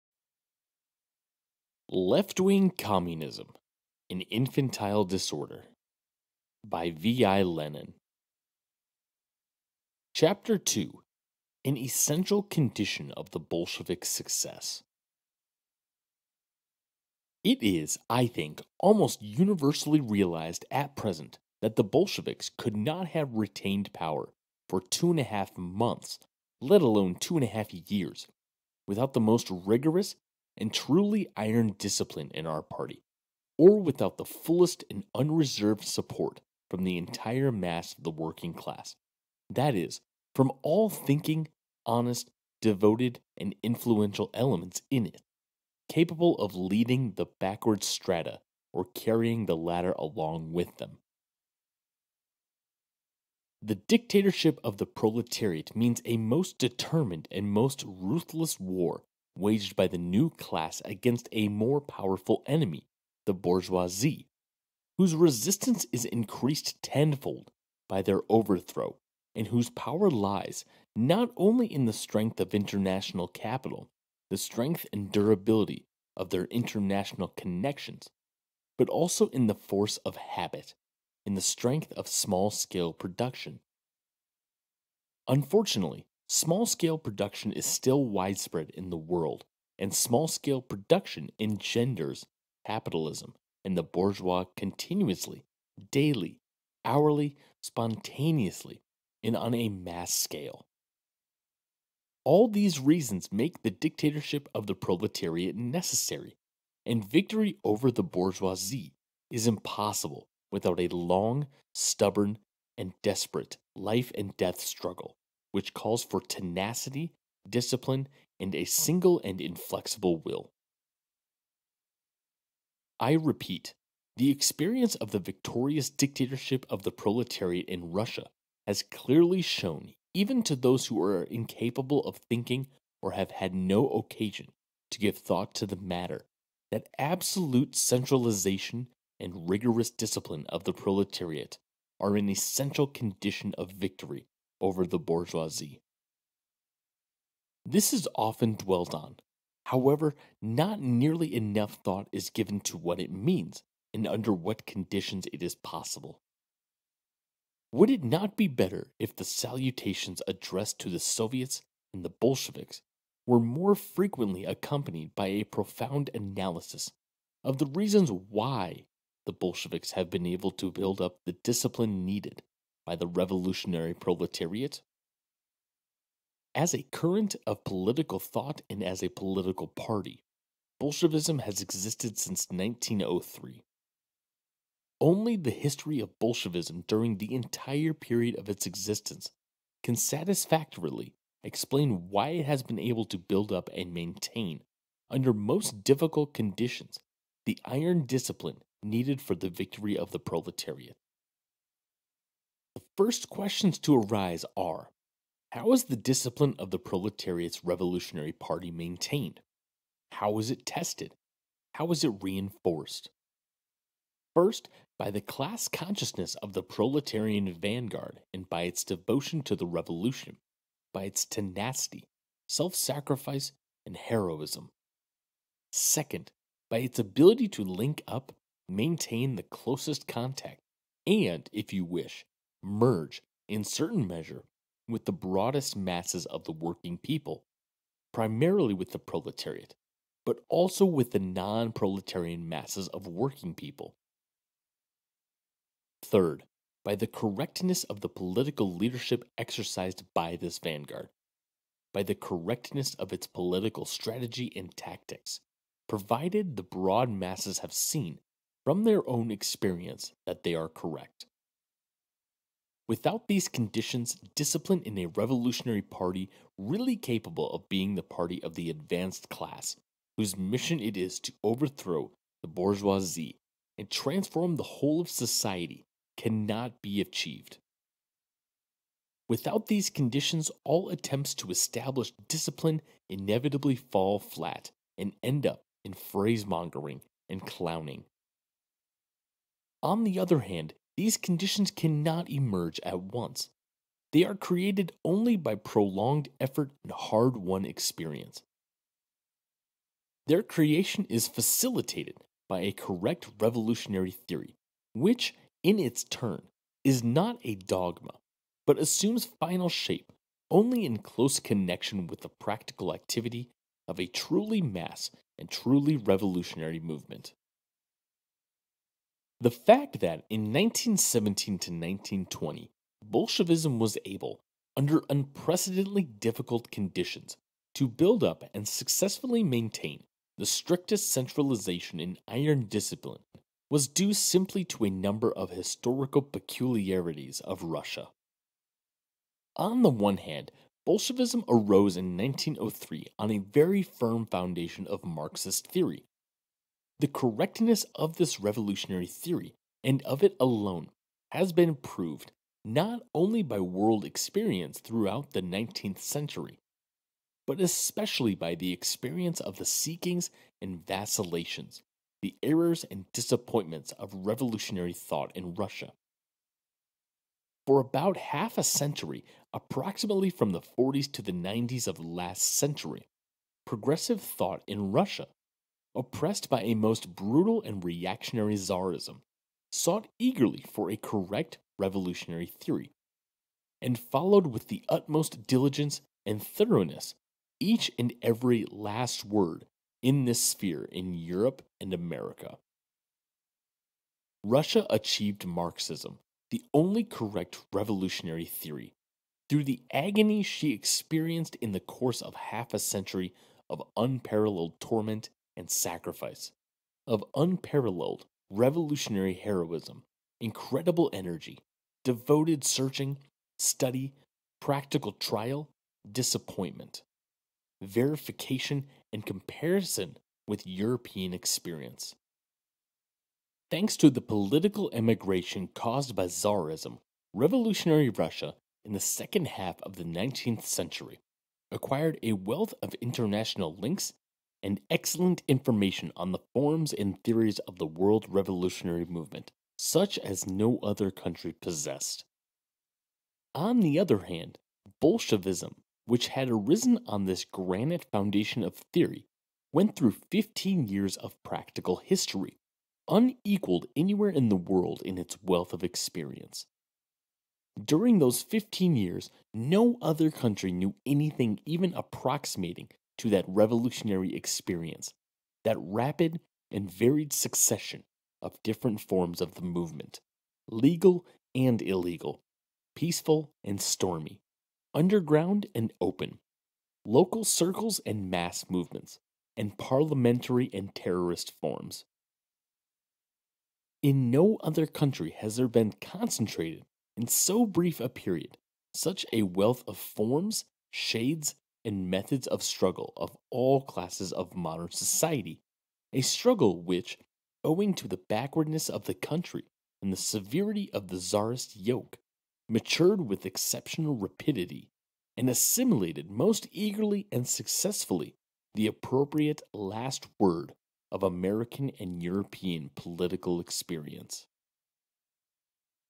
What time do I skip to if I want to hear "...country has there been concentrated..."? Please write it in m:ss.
8:04.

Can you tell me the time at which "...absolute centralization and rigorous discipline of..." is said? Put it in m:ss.
2:16.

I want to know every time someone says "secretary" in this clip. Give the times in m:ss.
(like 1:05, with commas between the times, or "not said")
not said.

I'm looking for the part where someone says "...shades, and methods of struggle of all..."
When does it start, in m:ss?
8:10.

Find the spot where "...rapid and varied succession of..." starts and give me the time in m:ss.
7:45.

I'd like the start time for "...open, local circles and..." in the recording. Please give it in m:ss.
7:56.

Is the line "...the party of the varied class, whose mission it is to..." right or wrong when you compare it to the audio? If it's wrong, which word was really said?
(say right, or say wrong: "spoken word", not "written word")
wrong: "advanced", not "varied".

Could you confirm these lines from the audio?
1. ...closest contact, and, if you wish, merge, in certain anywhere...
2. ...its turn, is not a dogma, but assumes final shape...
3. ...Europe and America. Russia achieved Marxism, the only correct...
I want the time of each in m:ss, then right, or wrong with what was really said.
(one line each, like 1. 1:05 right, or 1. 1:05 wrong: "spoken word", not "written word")
1. 3:49 wrong: "measure", not "anywhere"
2. 5:05 right
3. 6:31 right.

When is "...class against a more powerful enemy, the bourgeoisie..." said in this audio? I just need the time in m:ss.
1:00.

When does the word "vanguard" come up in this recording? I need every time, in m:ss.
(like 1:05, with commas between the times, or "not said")
3:37, 4:10.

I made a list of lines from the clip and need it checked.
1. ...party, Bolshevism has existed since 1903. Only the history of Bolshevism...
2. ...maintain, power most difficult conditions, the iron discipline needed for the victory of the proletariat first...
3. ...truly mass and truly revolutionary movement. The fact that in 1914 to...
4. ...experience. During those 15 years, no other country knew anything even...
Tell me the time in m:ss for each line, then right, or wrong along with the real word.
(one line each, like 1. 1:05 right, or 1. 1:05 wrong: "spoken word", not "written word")
1. 2:59 right
2. 3:13 wrong: "under", not "power"
3. 5:14 wrong: "1917", not "1914"
4. 7:35 right.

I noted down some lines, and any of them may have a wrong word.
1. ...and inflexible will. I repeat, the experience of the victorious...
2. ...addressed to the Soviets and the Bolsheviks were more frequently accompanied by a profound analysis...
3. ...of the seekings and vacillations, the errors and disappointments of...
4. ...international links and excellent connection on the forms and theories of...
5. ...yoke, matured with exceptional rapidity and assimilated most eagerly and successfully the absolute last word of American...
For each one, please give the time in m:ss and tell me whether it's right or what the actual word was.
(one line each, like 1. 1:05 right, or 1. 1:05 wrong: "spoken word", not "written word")
1. 1:59 right
2. 2:40 right
3. 5:59 right
4. 7:12 wrong: "information", not "connection"
5. 8:21 wrong: "appropriate", not "absolute".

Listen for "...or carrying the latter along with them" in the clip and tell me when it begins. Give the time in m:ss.
0:48.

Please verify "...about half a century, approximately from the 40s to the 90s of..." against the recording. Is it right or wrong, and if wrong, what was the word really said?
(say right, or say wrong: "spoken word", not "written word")
right.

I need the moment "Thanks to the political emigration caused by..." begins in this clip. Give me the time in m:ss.
7:03.